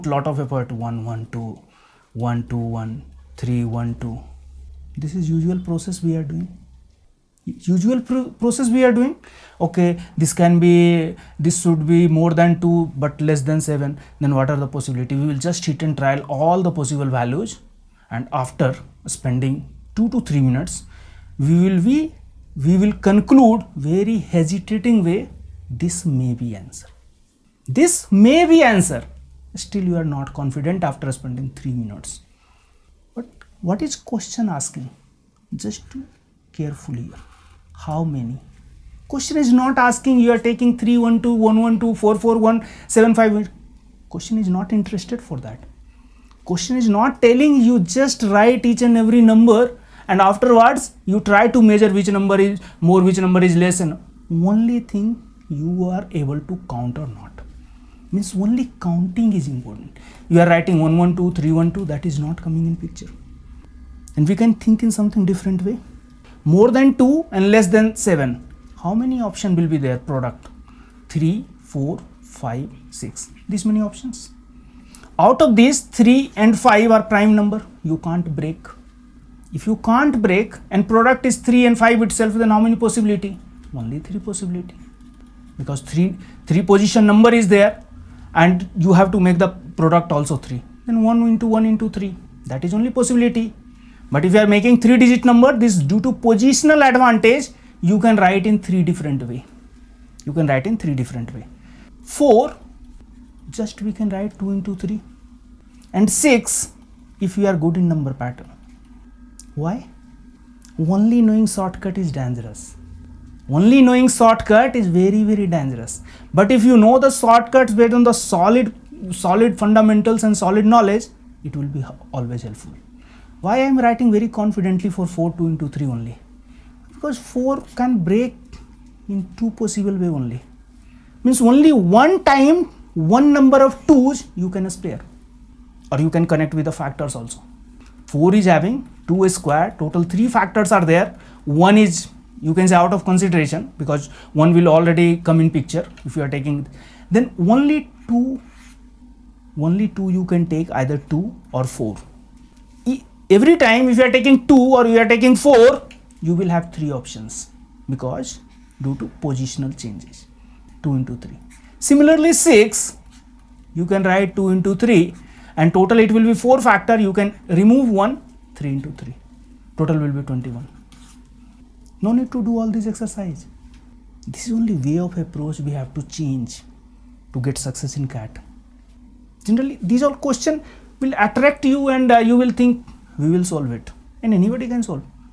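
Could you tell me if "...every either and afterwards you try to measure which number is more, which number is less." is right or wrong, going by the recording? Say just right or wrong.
wrong.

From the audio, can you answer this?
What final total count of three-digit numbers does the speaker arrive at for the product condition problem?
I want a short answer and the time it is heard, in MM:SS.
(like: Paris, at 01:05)
21, at 02:50.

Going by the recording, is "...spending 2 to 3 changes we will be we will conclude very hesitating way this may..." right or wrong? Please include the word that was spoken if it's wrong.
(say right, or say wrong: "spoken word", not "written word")
wrong: "minutes", not "changes".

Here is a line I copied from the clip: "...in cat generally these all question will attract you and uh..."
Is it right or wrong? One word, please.
right.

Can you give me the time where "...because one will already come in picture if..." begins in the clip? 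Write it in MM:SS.
02:23.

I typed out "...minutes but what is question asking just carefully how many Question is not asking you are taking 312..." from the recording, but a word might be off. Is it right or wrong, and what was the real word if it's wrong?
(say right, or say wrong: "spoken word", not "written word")
right.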